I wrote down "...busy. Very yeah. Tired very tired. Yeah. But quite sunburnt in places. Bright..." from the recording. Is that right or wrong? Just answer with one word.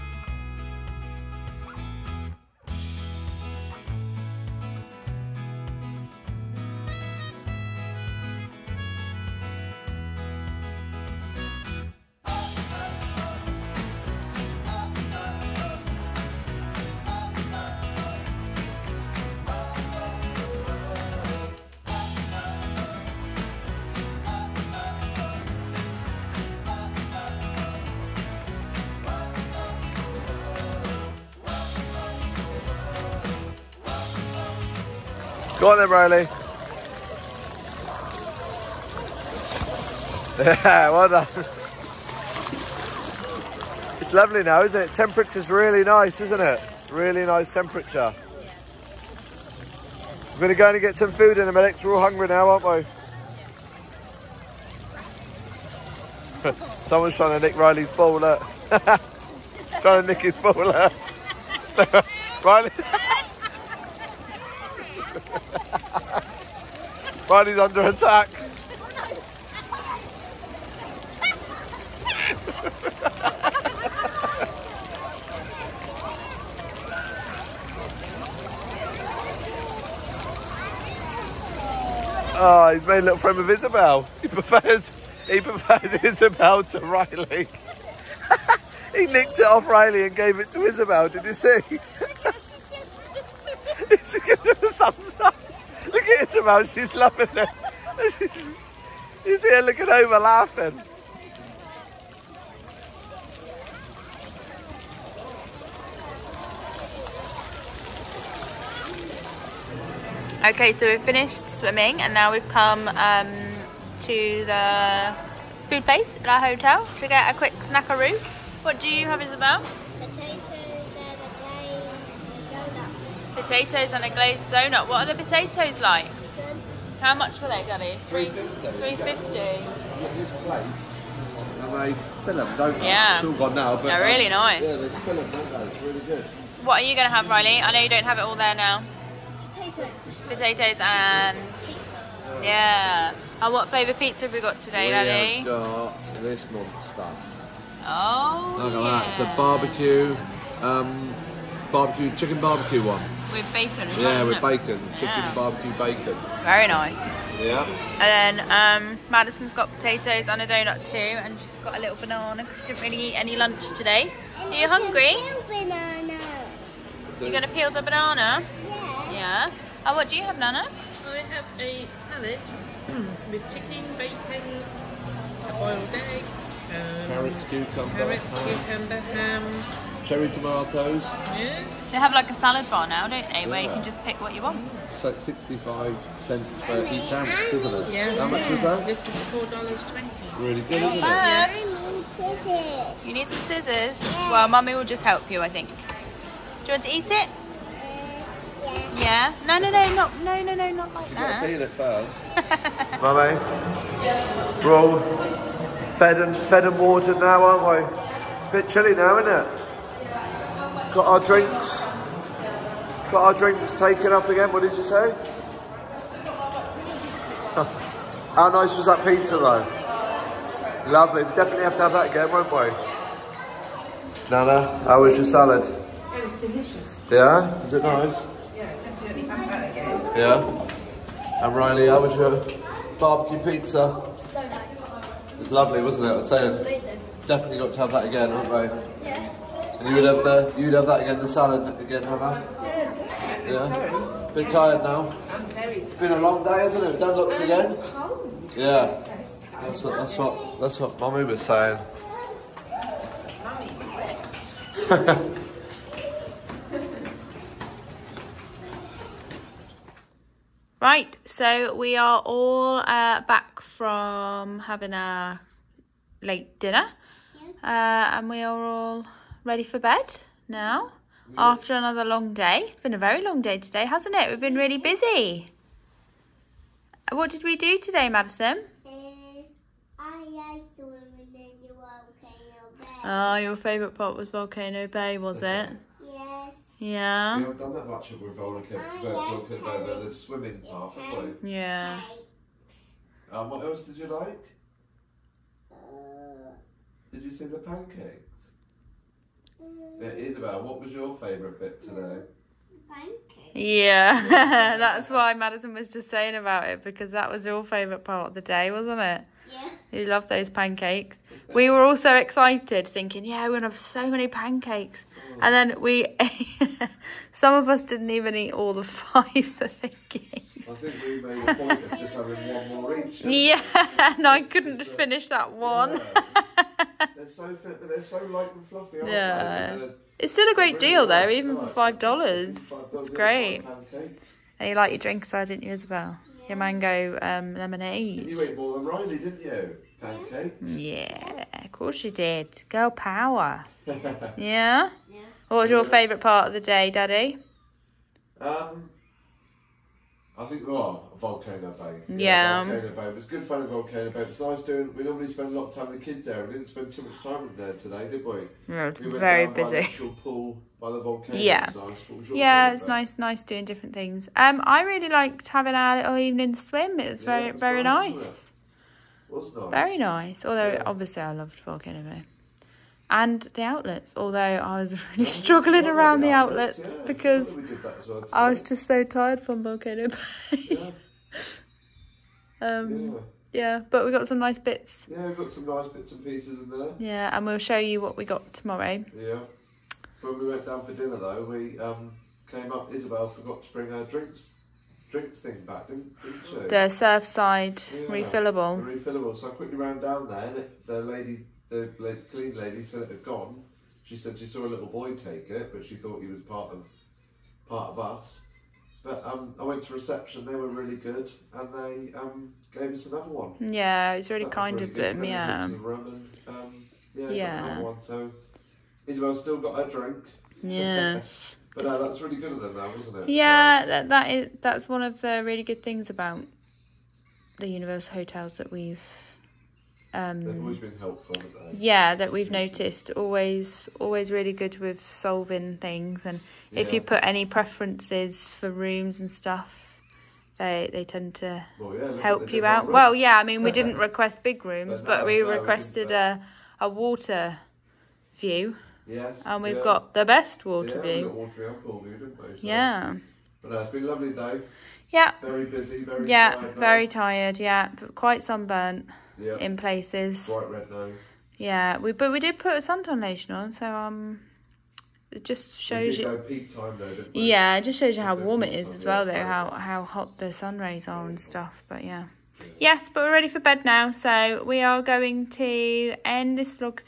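right.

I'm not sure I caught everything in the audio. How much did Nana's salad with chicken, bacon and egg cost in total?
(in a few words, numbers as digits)
$4.20.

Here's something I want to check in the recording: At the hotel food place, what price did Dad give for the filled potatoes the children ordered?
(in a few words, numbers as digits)
$3.50.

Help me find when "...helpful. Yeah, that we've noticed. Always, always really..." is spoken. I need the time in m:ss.
7:10.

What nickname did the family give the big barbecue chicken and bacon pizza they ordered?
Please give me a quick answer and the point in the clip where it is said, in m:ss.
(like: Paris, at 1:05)
monster, at 2:26.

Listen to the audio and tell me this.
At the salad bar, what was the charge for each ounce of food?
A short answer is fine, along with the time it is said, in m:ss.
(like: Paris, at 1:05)
65 cents, at 3:05.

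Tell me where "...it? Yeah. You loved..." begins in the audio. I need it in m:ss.
5:09.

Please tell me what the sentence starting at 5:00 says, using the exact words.
It is Isabel, what was your favourite bit today?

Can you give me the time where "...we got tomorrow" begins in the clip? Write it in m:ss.
6:28.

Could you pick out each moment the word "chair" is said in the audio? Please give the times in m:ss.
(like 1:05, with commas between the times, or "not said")
not said.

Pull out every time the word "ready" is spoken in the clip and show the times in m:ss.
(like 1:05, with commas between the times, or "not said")
4:29, 7:53.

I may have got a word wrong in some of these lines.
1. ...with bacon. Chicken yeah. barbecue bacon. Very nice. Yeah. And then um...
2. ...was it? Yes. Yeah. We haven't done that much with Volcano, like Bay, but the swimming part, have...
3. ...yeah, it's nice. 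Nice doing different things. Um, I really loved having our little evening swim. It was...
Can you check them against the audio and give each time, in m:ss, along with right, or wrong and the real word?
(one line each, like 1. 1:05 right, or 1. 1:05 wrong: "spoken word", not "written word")
1. 2:34 right
2. 4:45 right
3. 6:02 wrong: "liked", not "loved".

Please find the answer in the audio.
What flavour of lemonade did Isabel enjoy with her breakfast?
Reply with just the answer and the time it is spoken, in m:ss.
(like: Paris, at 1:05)
mango, at 5:36.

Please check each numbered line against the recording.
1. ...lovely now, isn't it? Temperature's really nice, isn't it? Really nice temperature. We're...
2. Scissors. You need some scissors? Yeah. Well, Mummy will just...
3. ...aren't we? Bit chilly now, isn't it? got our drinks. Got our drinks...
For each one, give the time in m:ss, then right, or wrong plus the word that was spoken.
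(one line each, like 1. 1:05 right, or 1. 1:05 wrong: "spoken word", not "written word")
1. 0:44 right
2. 3:12 right
3. 3:27 right.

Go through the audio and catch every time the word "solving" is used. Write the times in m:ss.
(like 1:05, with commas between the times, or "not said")
7:15.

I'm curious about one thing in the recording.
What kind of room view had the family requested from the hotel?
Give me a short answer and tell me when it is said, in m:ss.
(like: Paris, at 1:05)
water view, at 7:26.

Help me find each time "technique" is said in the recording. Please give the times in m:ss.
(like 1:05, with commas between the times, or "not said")
not said.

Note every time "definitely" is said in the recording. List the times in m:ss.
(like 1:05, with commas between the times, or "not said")
3:41, 3:48, 3:57.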